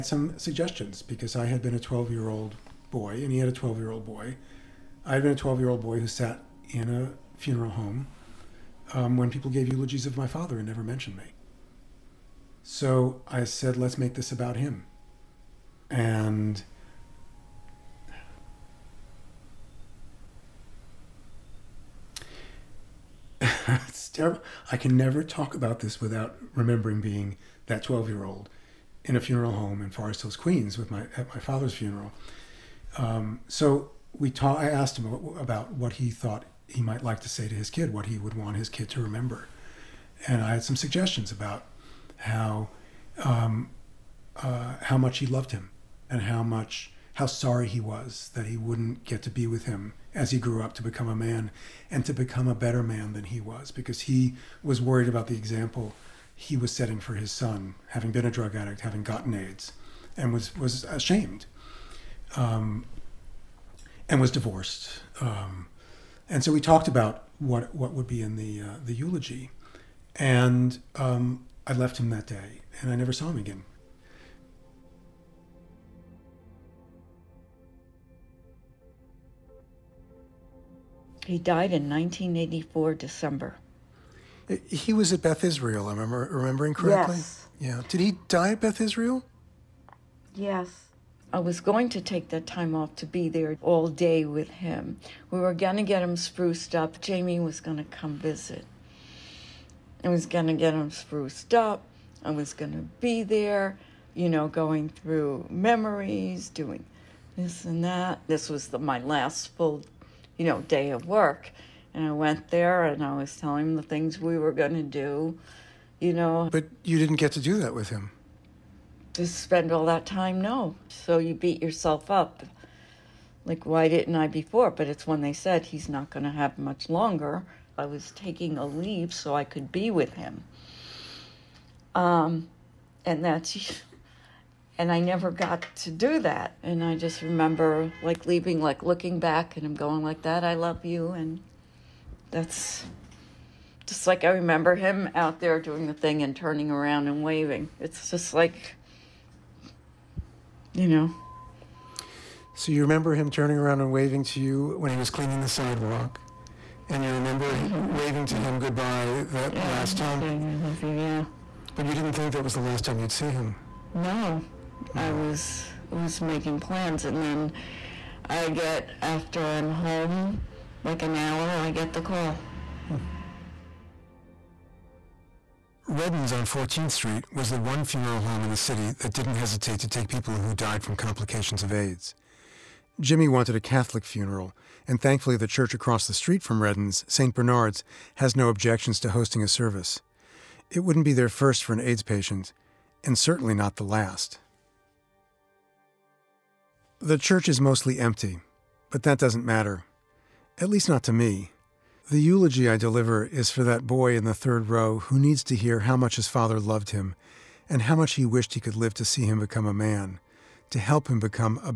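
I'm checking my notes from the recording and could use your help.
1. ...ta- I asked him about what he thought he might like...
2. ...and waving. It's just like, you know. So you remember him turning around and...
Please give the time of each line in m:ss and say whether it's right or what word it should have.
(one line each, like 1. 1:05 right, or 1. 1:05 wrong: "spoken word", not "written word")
1. 0:34 right
2. 2:27 right.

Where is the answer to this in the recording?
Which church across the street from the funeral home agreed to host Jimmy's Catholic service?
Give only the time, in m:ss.
3:07.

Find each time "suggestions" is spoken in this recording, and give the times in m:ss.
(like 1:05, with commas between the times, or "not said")
0:00, 0:40.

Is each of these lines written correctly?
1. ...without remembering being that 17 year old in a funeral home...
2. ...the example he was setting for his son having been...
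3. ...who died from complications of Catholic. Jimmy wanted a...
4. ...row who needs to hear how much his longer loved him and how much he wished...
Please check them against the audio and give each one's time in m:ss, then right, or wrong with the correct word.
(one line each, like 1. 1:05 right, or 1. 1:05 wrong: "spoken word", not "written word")
1. 0:26 wrong: "12", not "17"
2. 0:55 right
3. 3:00 wrong: "AIDS", not "Catholic"
4. 3:24 wrong: "father", not "longer".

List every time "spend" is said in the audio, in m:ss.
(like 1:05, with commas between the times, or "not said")
1:59.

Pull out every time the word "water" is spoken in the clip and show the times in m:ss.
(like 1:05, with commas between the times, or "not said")
not said.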